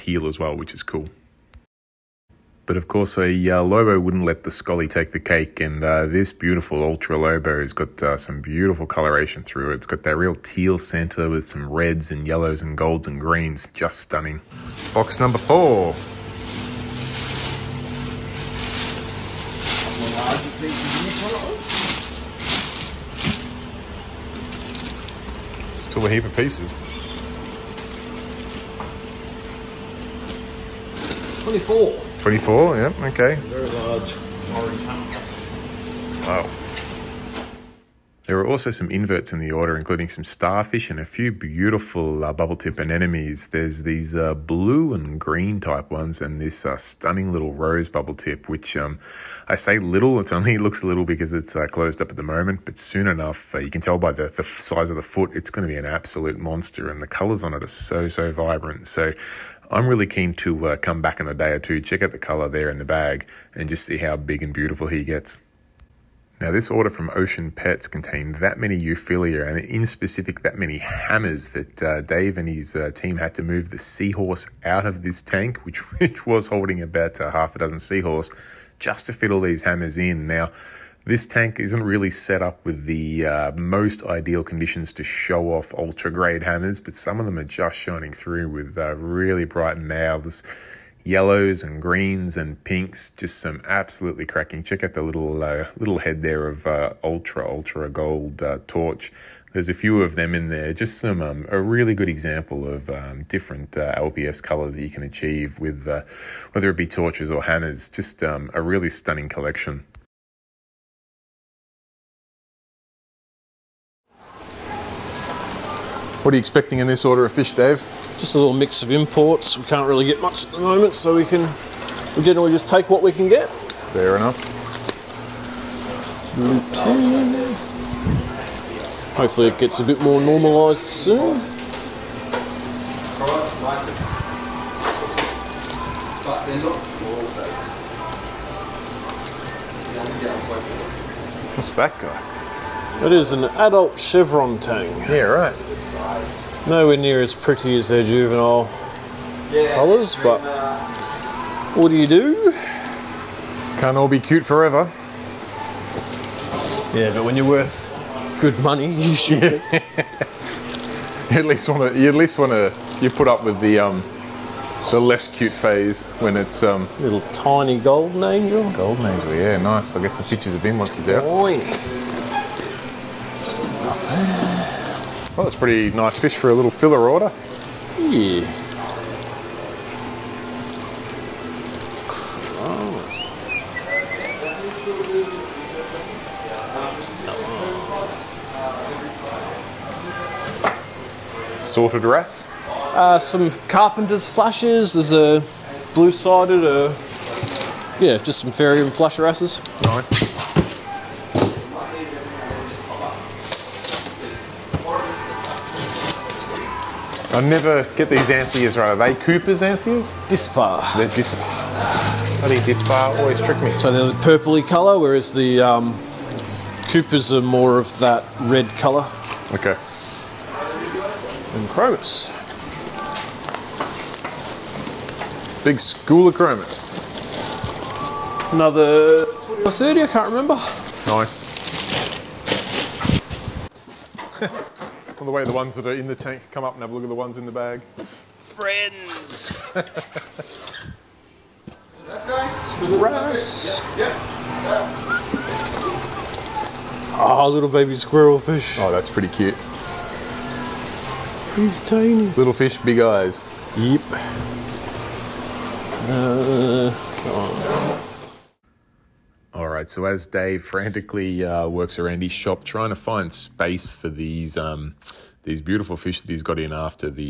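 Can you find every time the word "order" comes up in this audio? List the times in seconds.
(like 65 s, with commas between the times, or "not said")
39 s, 66 s, 117 s, 177 s.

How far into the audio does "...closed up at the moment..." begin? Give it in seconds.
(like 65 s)
51 s.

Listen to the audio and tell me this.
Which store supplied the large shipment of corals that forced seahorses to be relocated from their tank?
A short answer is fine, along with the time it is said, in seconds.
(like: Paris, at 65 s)
Ocean Pets, at 67 s.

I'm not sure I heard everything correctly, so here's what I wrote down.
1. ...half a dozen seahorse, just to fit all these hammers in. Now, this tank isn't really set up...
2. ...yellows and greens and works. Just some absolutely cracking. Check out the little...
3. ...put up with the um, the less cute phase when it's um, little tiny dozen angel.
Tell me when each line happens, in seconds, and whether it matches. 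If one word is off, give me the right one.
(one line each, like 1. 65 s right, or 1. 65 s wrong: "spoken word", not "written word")
1. 77 s right
2. 91 s wrong: "pinks", not "works"
3. 163 s wrong: "golden", not "dozen".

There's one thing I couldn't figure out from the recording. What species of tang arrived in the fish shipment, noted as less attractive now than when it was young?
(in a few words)
Chevron tang.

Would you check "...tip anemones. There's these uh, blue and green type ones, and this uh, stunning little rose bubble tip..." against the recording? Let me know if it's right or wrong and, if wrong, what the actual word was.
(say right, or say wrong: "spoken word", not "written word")
right.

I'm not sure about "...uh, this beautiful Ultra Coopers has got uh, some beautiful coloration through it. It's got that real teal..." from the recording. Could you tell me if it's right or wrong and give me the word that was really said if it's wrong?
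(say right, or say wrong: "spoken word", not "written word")
wrong: "Lobo", not "Coopers".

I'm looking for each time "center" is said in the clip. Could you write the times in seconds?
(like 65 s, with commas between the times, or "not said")
10 s.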